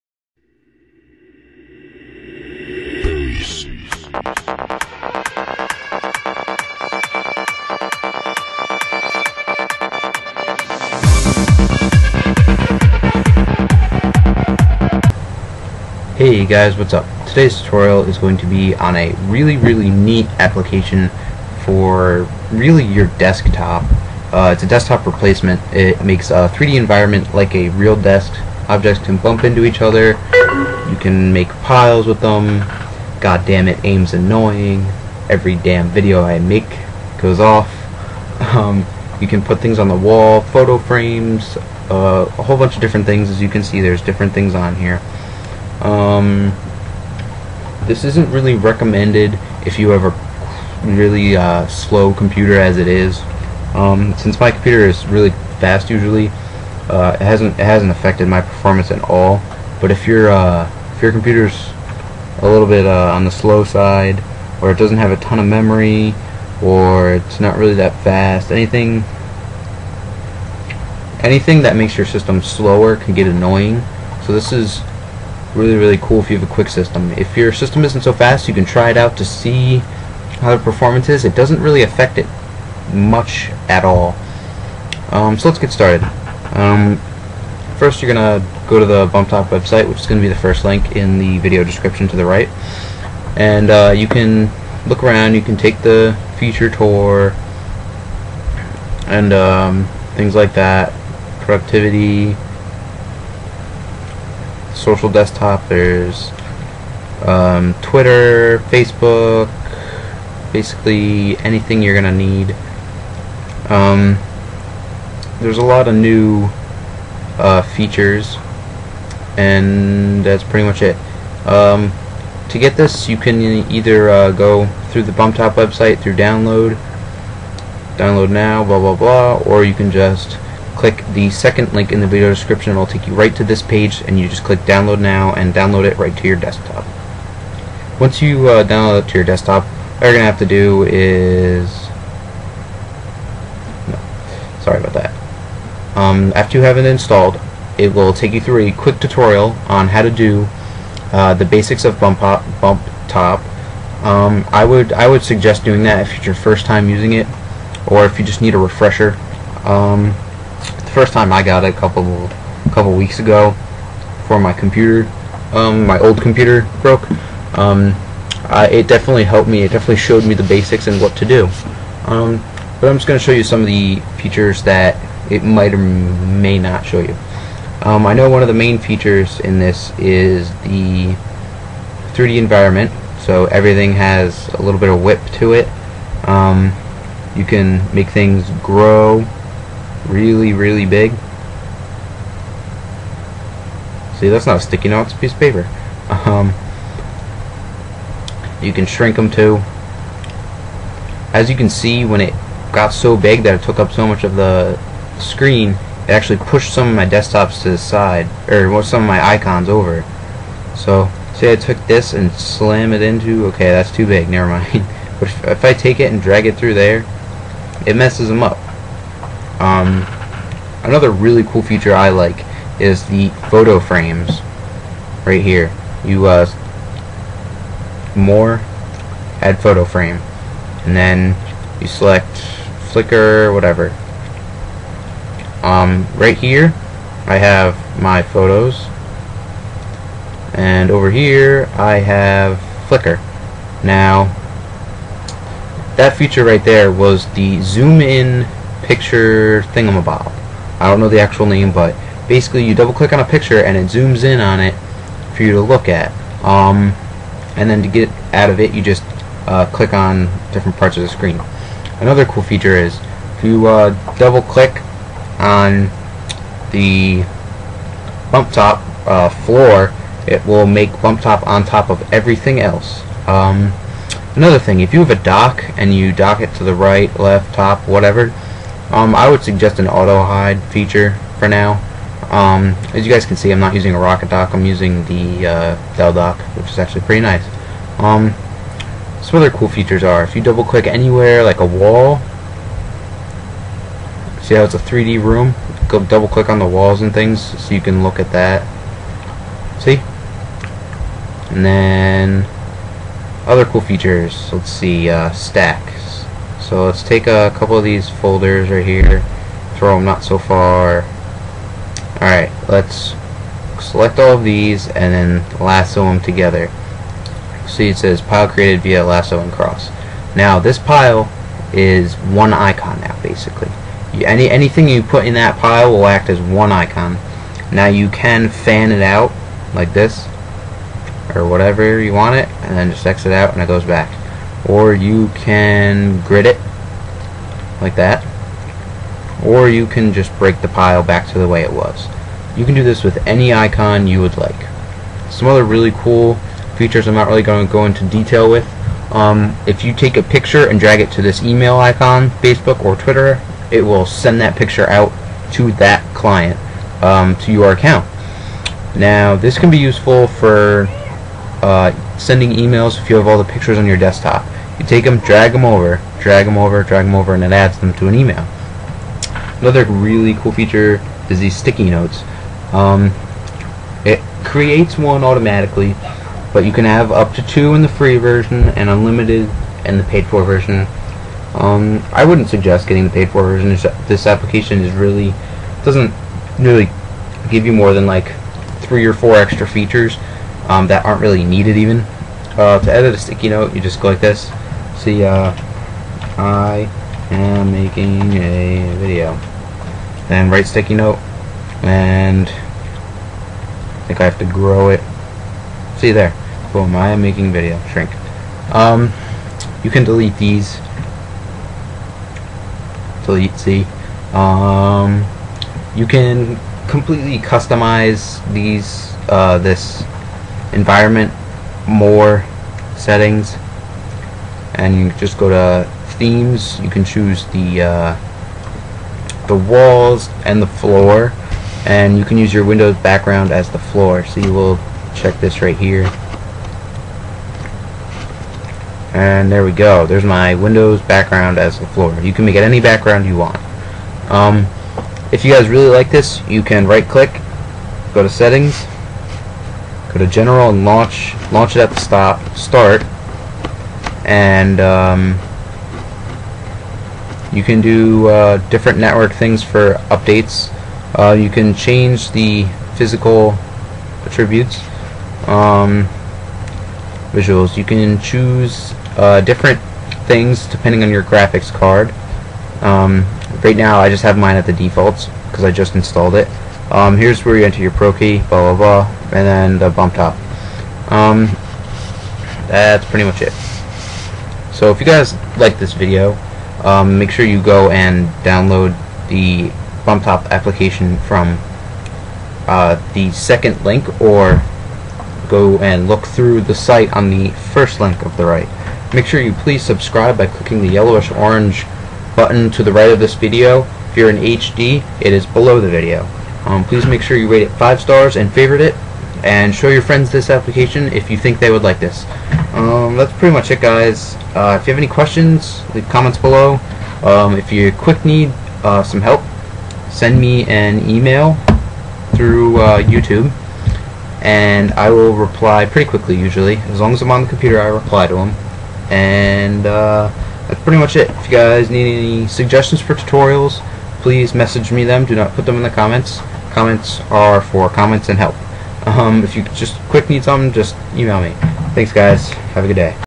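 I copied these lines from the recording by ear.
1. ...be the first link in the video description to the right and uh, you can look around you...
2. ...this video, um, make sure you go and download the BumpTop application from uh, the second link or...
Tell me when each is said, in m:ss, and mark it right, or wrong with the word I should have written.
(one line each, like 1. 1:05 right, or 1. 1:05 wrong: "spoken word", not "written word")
1. 1:30 right
2. 8:05 right.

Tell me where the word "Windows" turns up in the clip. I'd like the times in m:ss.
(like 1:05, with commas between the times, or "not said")
7:12, 7:20.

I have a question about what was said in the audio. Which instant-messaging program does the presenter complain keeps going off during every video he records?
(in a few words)
AIM.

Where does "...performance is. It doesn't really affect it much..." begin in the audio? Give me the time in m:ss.
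1:20.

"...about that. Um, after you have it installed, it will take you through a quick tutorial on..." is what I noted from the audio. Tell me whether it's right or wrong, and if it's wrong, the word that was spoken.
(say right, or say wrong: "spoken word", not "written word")
right.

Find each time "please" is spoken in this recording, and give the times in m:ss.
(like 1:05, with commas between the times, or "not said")
8:19, 8:26, 8:54.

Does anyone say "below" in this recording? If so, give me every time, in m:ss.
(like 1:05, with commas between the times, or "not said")
8:25, 8:36.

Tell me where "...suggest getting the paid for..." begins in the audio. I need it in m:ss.
6:22.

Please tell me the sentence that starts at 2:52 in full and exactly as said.
Um, but I'm just going to show you some of the features that it might or may not show you.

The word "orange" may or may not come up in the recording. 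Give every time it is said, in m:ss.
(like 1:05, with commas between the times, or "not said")
8:21.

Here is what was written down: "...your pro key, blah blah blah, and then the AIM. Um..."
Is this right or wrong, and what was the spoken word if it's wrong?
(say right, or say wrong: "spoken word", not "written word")
wrong: "BumpTop", not "AIM".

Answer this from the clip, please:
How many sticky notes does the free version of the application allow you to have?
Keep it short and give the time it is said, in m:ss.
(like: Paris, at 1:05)
2, at 6:17.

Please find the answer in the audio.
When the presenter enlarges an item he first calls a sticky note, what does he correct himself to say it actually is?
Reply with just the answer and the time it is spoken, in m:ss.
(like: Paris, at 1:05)
a piece of paper, at 3:15.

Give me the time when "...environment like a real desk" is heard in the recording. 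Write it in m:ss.
0:26.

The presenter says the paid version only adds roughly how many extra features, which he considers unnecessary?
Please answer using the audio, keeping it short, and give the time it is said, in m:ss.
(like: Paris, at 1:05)
three or four, at 6:28.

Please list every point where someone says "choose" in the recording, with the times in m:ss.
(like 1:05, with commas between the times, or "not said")
7:07, 7:48.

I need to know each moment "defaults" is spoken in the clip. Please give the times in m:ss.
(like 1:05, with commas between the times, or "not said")
7:54.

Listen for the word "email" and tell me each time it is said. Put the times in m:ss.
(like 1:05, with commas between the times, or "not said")
5:51, 6:02, 6:08, 8:41, 9:01.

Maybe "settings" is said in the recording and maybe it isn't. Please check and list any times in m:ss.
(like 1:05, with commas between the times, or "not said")
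7:02, 7:28.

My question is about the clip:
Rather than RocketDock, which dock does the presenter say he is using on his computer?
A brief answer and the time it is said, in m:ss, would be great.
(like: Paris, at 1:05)
Dell dock, at 4:45.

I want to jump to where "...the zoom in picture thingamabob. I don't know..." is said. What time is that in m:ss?
4:07.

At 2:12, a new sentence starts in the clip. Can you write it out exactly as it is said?
It'll take you right to this page, and you just click download now and download it right to your desktop.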